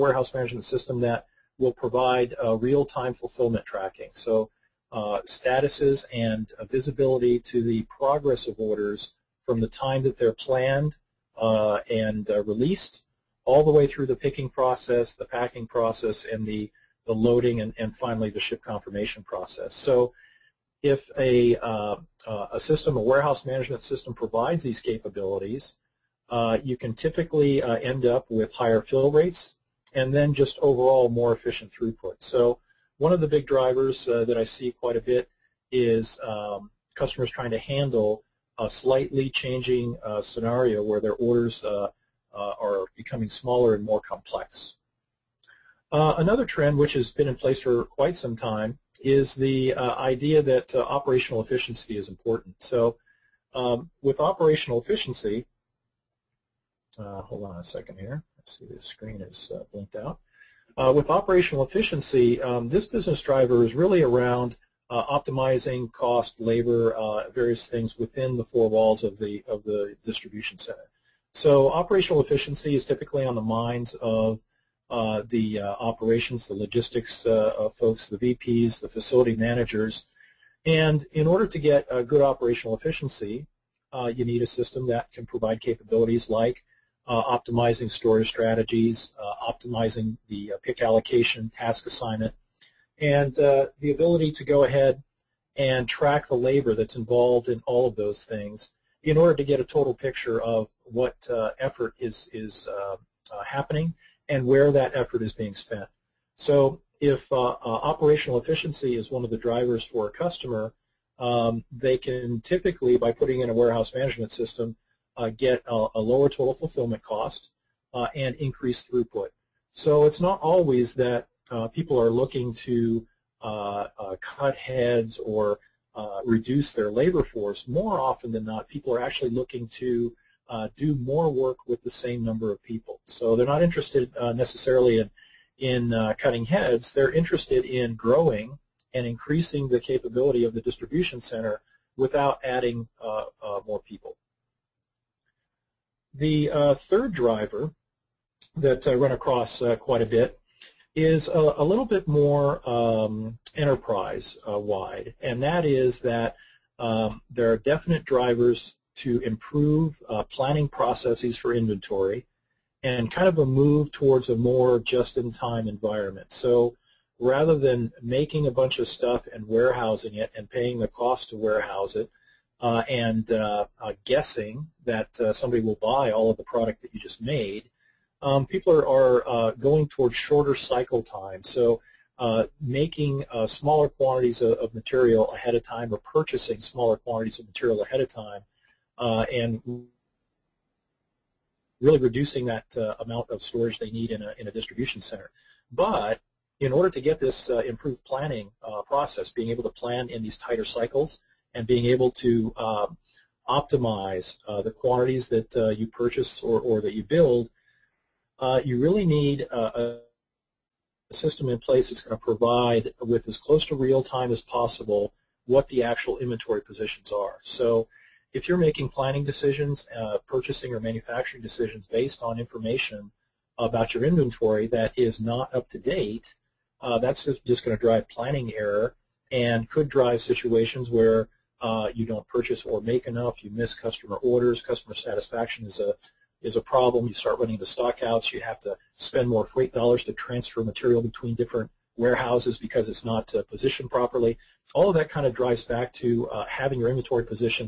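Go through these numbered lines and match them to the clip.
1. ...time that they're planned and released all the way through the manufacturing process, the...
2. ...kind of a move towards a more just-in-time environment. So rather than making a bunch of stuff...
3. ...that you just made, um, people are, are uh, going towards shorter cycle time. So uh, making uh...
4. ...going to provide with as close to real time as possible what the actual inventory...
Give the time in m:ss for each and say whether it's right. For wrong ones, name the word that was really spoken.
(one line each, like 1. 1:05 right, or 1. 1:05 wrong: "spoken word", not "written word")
1. 0:09 wrong: "picking", not "manufacturing"
2. 2:43 right
3. 2:56 right
4. 3:32 right.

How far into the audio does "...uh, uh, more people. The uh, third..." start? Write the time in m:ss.
2:23.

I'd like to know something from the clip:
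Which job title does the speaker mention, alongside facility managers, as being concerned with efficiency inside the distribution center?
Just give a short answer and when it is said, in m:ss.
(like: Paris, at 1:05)
VPs, at 1:18.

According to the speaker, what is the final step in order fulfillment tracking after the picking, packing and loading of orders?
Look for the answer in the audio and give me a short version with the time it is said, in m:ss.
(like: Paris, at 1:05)
Ship confirmation, at 0:18.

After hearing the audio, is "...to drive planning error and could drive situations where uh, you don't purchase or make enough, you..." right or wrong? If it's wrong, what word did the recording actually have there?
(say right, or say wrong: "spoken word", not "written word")
right.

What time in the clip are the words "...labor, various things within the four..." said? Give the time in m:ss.
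1:06.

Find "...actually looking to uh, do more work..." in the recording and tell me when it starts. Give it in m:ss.
2:09.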